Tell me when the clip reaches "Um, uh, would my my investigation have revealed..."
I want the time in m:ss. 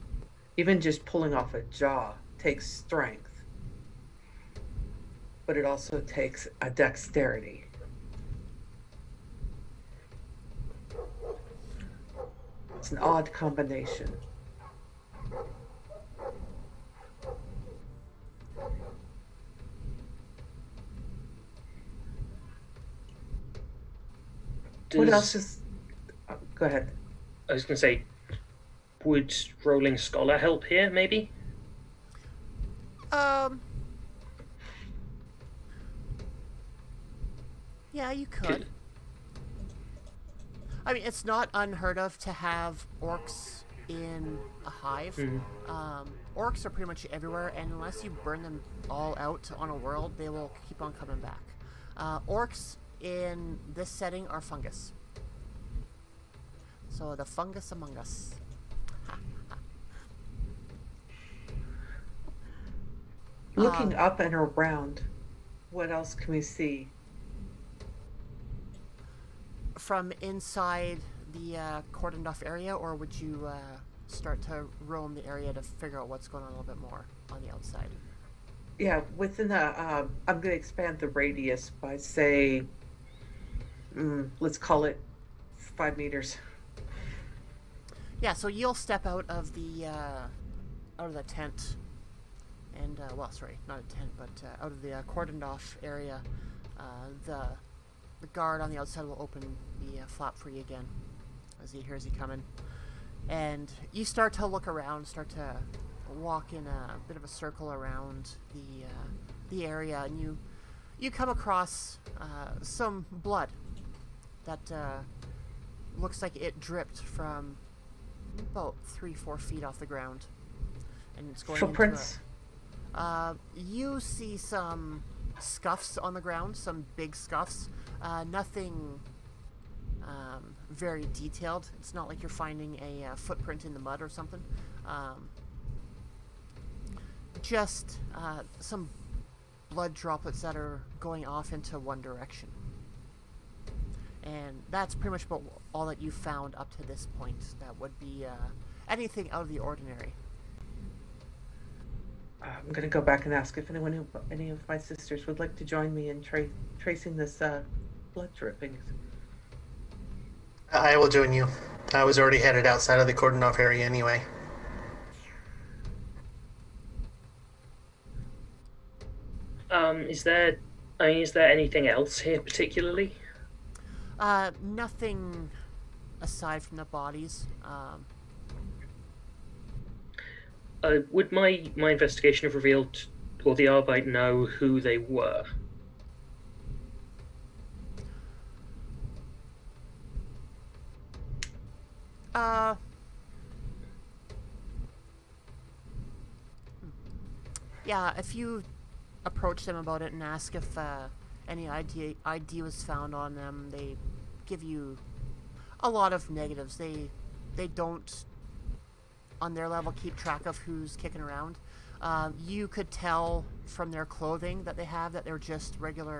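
2:57.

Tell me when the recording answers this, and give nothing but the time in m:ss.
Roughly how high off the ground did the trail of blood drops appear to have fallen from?
1:58.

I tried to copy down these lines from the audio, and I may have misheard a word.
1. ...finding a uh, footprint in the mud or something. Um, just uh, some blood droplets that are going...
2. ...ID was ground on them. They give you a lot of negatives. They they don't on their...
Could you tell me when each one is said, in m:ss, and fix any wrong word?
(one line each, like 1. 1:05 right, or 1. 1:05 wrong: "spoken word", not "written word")
1. 2:12 right
2. 3:22 wrong: "found", not "ground".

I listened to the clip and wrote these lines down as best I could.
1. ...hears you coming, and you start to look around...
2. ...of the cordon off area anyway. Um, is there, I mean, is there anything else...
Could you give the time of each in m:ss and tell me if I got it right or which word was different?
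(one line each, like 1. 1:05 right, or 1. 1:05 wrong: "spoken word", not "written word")
1. 1:41 right
2. 2:42 right.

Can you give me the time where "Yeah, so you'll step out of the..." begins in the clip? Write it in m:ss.
1:28.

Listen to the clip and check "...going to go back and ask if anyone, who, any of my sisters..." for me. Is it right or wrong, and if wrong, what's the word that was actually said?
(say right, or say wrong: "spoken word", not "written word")
right.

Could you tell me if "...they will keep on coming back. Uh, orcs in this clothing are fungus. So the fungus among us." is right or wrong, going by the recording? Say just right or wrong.
wrong.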